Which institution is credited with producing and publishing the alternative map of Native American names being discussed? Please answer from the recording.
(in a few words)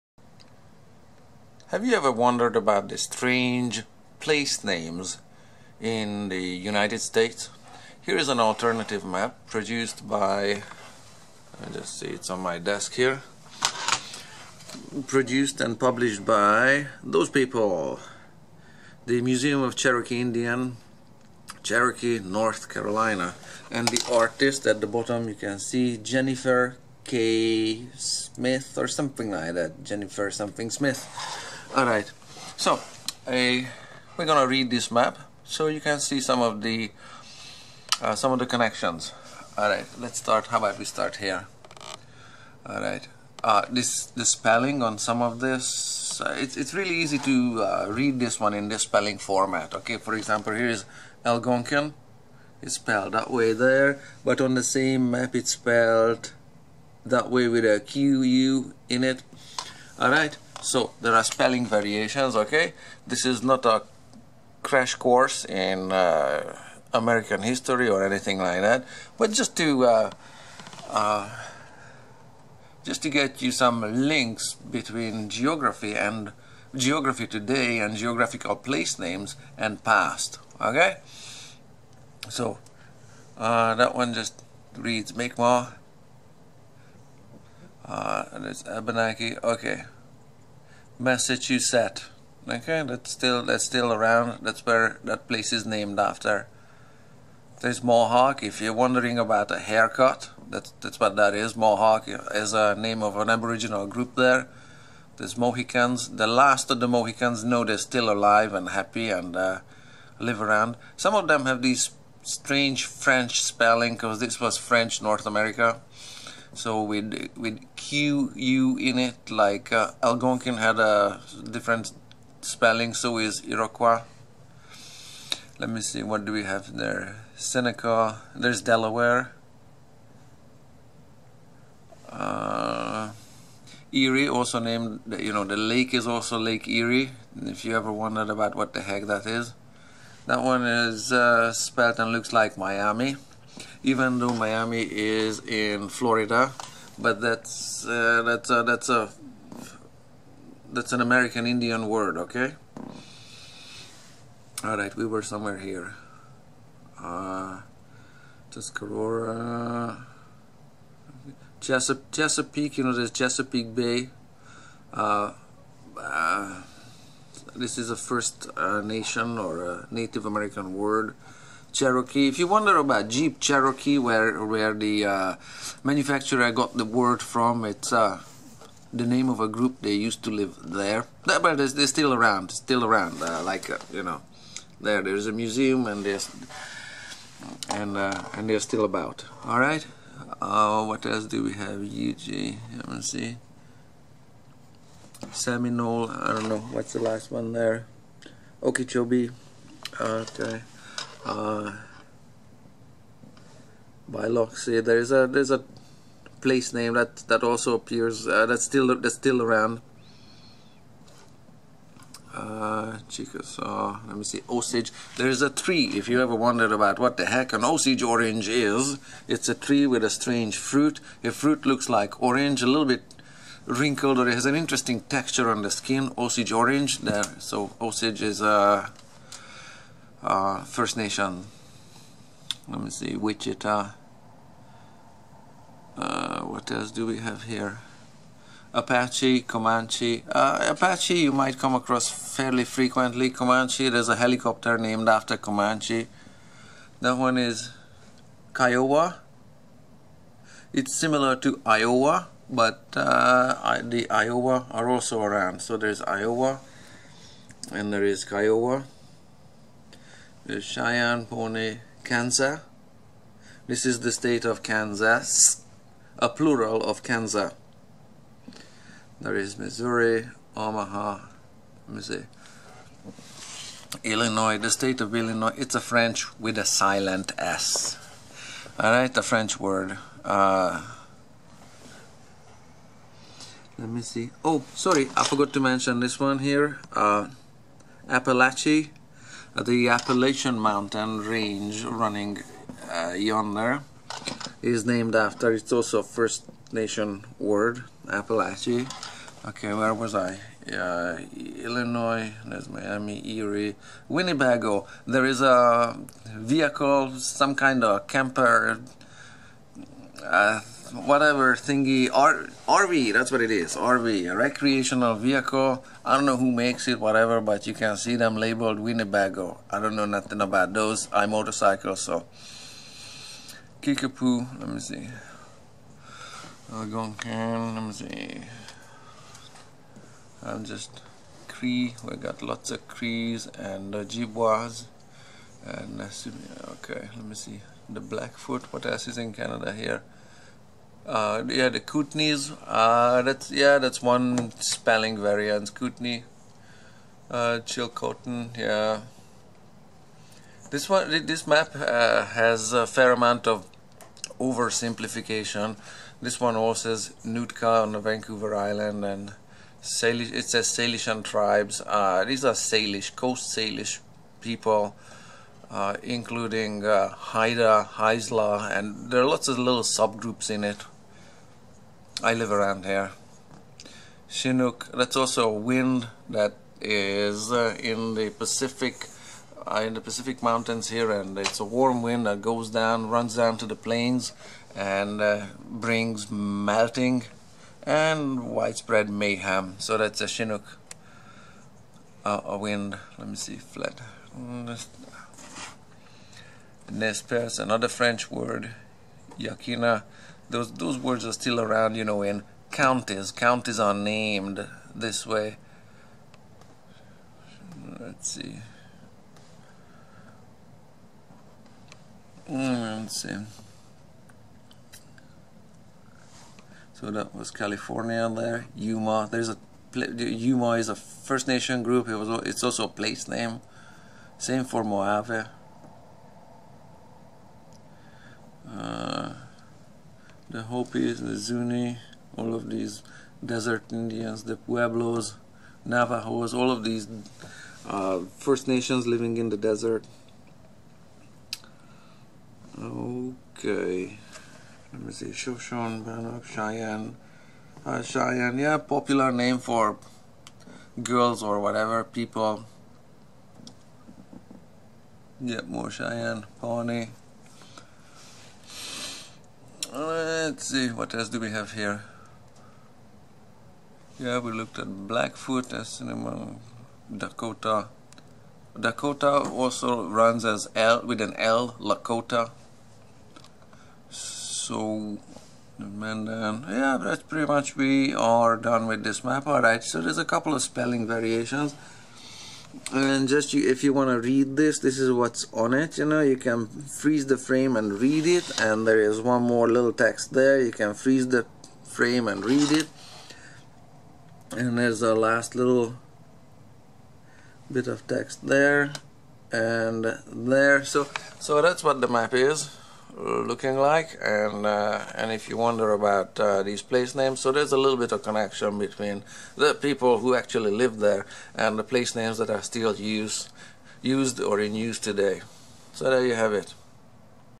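Museum of Cherokee Indian.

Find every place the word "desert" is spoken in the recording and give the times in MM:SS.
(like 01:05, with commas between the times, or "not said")
07:13, 07:19.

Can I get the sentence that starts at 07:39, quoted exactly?
Let's see, what else do we have here?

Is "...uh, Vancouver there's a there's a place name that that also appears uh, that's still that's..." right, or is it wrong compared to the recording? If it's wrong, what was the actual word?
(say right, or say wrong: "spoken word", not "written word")
wrong: "Biloxi", not "Vancouver".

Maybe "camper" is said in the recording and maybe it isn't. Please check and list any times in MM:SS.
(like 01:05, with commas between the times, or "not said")
05:08.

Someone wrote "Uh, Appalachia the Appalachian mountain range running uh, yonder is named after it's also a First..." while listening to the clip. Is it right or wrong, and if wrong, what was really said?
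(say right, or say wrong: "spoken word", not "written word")
right.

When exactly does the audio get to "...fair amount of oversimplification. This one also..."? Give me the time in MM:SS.
05:52.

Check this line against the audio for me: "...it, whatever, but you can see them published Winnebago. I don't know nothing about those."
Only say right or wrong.
wrong.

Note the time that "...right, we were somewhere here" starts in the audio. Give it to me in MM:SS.
02:34.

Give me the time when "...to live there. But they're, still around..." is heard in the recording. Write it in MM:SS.
03:00.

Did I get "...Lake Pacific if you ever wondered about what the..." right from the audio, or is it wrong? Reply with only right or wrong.
wrong.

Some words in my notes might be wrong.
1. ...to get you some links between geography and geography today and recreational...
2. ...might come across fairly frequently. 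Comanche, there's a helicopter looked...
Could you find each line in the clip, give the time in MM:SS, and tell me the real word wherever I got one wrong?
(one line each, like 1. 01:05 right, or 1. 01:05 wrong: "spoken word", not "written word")
1. 01:13 wrong: "geographical", not "recreational"
2. 04:01 wrong: "named", not "looked".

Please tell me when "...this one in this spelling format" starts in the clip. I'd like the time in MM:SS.
00:48.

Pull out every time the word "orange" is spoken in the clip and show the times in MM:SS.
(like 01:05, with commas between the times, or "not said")
03:38, 03:42, 03:46.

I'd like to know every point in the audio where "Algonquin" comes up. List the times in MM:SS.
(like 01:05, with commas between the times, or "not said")
00:51, 02:00, 05:26.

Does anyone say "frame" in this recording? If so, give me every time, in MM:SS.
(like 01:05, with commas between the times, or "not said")
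08:07, 08:11.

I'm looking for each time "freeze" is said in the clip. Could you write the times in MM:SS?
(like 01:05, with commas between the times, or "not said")
08:06, 08:10.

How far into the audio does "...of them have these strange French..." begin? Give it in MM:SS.
01:51.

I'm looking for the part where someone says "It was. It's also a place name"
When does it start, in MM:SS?
07:02.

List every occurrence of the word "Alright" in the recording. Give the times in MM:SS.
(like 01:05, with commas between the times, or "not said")
04:38, 07:59.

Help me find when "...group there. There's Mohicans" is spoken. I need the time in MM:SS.
01:43.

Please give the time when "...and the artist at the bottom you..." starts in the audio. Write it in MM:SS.
00:23.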